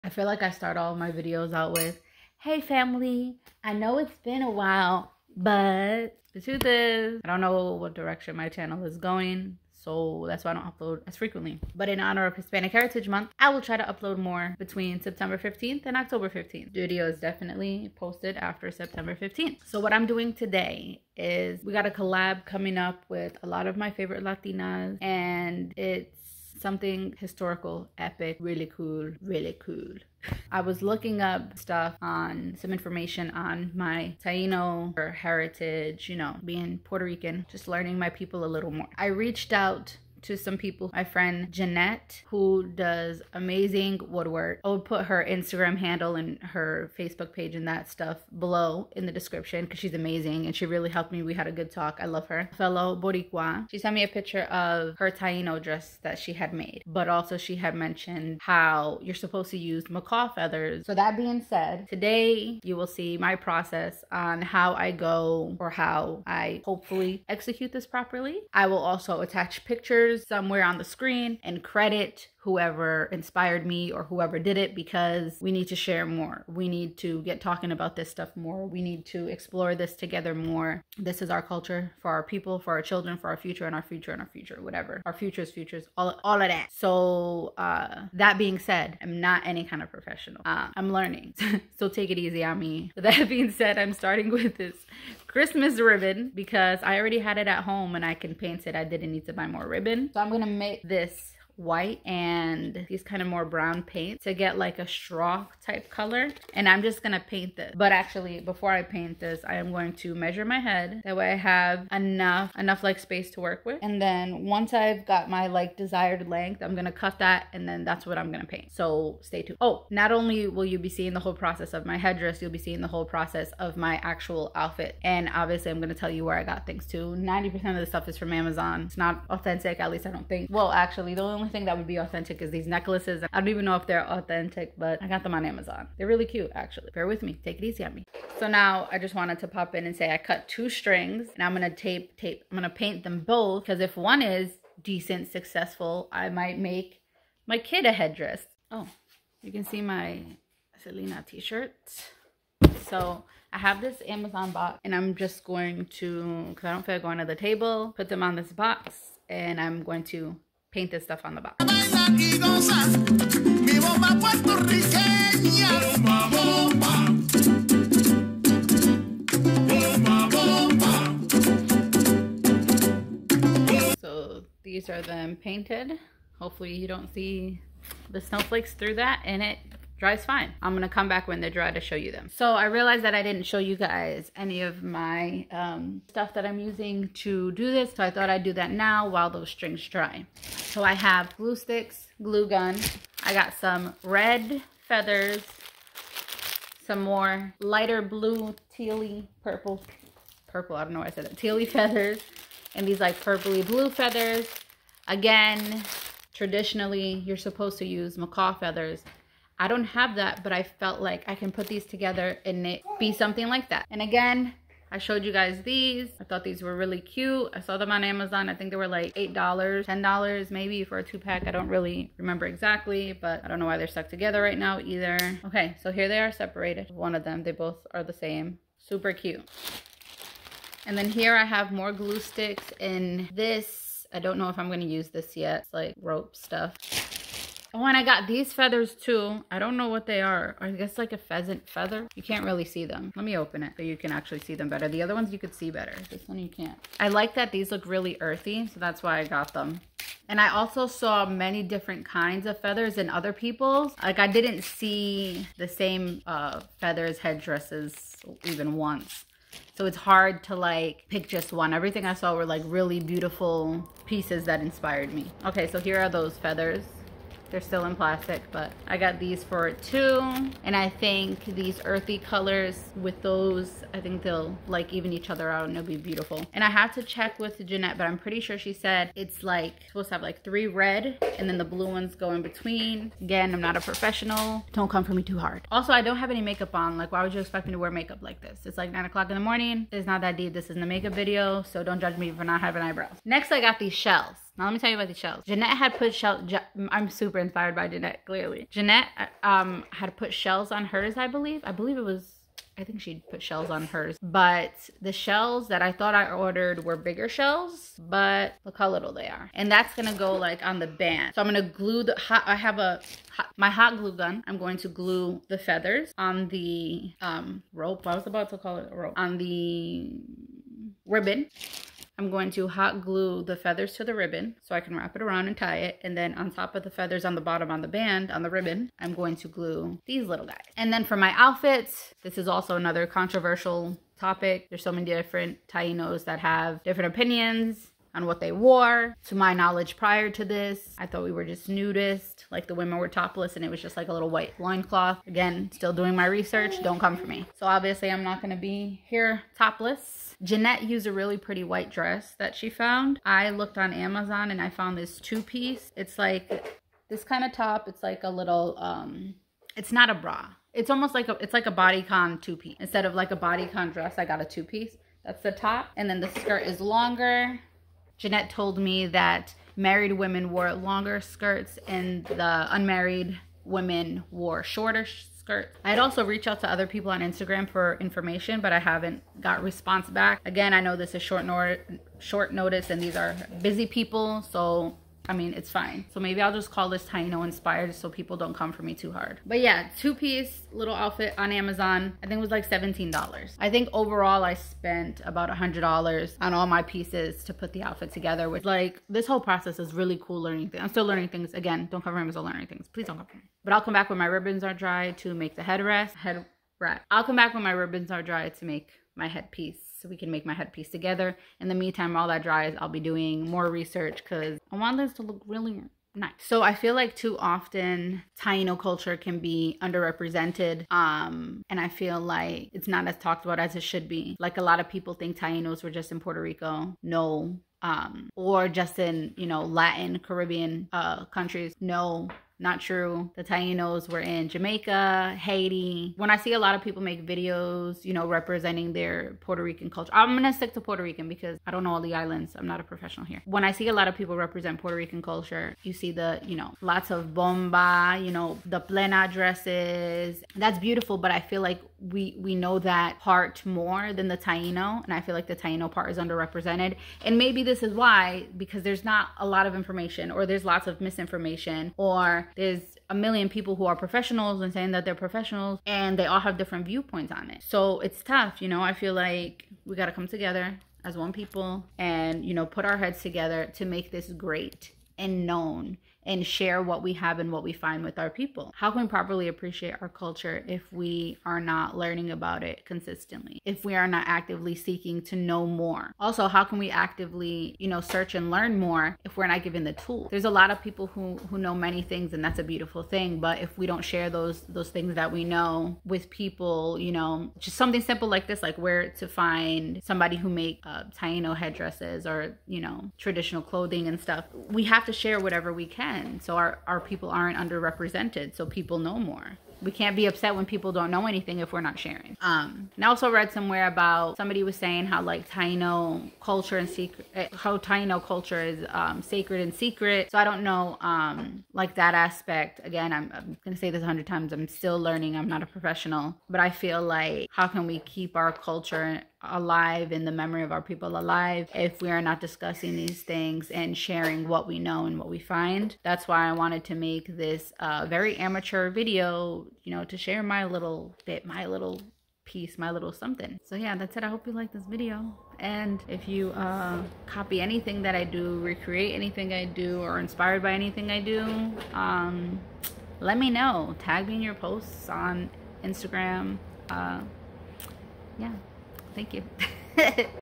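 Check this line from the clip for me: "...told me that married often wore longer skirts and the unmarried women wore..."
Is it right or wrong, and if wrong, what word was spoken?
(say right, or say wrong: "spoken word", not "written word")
wrong: "women", not "often".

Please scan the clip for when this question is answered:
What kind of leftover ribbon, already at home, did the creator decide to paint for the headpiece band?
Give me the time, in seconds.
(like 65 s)
95 s.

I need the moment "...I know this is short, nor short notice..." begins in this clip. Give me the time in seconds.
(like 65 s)
380 s.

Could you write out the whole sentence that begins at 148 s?
Oh, you can see my Selena t-shirt.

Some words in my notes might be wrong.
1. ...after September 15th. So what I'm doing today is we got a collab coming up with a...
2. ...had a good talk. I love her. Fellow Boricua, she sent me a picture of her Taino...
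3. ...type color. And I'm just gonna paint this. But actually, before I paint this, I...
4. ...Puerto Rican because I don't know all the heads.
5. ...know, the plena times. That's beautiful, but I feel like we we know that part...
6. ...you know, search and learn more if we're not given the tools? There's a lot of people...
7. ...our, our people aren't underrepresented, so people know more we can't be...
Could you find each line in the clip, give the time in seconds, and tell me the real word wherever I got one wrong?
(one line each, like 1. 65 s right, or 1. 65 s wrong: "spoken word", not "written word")
1. 18 s right
2. 51 s right
3. 105 s right
4. 440 s wrong: "islands", not "heads"
5. 448 s wrong: "dresses", not "times"
6. 487 s right
7. 506 s right.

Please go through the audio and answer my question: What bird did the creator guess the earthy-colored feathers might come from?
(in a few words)
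Pheasant.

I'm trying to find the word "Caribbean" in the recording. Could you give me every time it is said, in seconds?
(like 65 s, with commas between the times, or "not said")
430 s.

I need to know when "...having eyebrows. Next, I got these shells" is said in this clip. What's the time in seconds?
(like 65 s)
292 s.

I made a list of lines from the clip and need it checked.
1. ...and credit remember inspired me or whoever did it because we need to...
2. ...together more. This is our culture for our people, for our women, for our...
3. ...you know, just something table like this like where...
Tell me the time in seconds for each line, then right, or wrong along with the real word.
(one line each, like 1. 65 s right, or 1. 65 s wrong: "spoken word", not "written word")
1. 71 s wrong: "whoever", not "remember"
2. 79 s wrong: "children", not "women"
3. 496 s wrong: "simple", not "table".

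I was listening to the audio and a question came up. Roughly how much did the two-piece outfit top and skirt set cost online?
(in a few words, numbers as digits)
$17.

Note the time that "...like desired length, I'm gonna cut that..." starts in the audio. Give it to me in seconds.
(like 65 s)
115 s.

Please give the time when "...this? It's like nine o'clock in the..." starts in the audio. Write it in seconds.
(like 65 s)
288 s.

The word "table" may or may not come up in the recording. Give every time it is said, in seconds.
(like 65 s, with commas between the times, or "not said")
157 s.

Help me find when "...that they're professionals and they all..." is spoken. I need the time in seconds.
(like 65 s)
464 s.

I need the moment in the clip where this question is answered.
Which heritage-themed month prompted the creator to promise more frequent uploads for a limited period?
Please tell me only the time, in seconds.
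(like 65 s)
12 s.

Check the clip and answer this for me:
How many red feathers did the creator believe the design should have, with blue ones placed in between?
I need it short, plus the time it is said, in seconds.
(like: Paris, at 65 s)
3, at 280 s.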